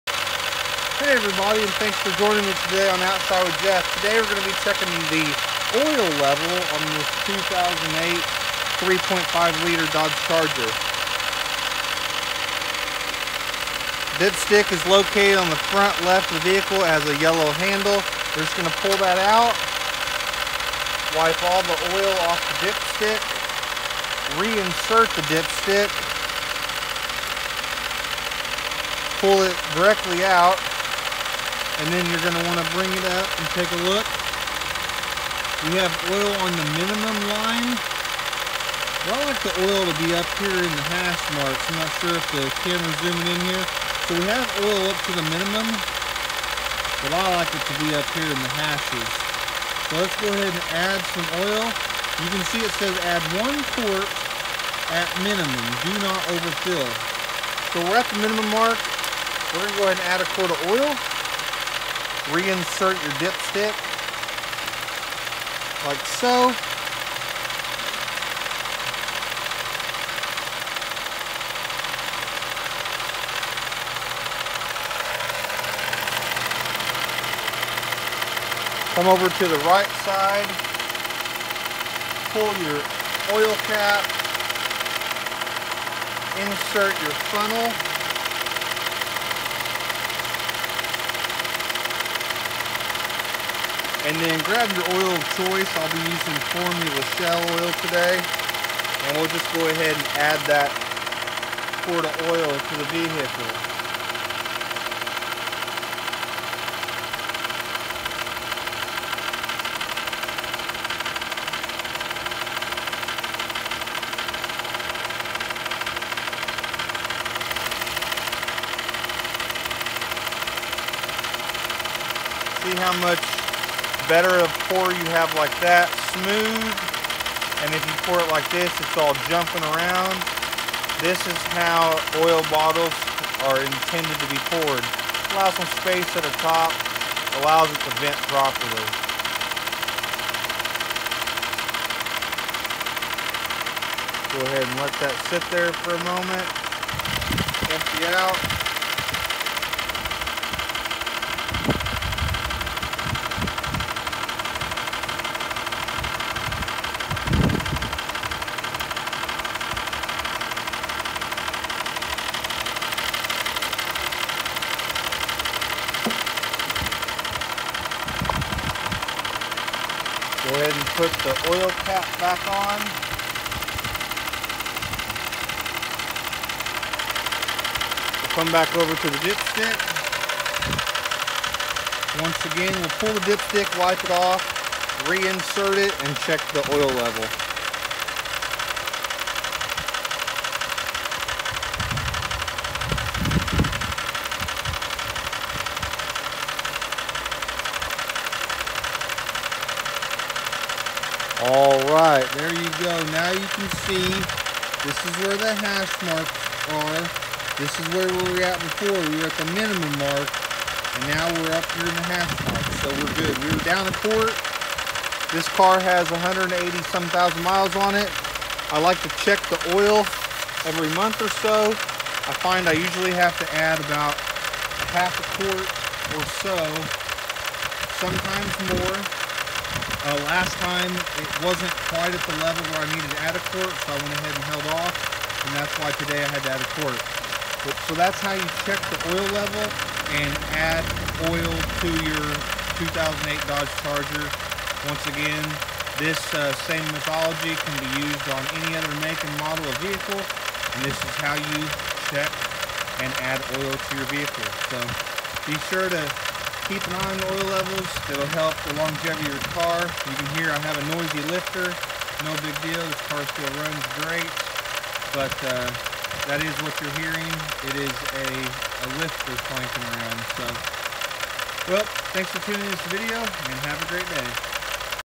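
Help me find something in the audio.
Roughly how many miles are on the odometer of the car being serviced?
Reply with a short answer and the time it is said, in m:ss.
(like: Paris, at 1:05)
180 some thousand, at 3:36.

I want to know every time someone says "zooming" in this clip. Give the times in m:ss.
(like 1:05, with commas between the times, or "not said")
0:43.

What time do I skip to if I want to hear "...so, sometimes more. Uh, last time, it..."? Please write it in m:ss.
3:46.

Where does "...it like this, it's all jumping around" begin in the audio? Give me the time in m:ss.
2:08.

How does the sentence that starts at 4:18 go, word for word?
It'll help the longevity of your car.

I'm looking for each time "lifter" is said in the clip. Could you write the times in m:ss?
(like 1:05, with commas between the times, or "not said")
4:21, 4:29.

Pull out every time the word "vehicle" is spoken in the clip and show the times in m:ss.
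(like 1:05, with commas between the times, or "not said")
0:16, 1:42, 4:09, 4:14.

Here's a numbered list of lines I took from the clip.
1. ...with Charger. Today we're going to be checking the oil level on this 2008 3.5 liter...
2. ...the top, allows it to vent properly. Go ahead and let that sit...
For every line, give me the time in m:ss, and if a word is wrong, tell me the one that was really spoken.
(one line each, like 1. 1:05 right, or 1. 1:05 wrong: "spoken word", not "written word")
1. 0:03 wrong: "Jeff", not "Charger"
2. 2:16 right.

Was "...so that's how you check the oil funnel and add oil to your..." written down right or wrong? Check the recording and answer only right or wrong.
wrong.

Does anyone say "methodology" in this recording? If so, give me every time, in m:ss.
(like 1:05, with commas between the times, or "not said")
4:06.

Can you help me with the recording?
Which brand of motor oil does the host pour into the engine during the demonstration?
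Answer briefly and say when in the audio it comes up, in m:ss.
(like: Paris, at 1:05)
Formula Shell, at 1:36.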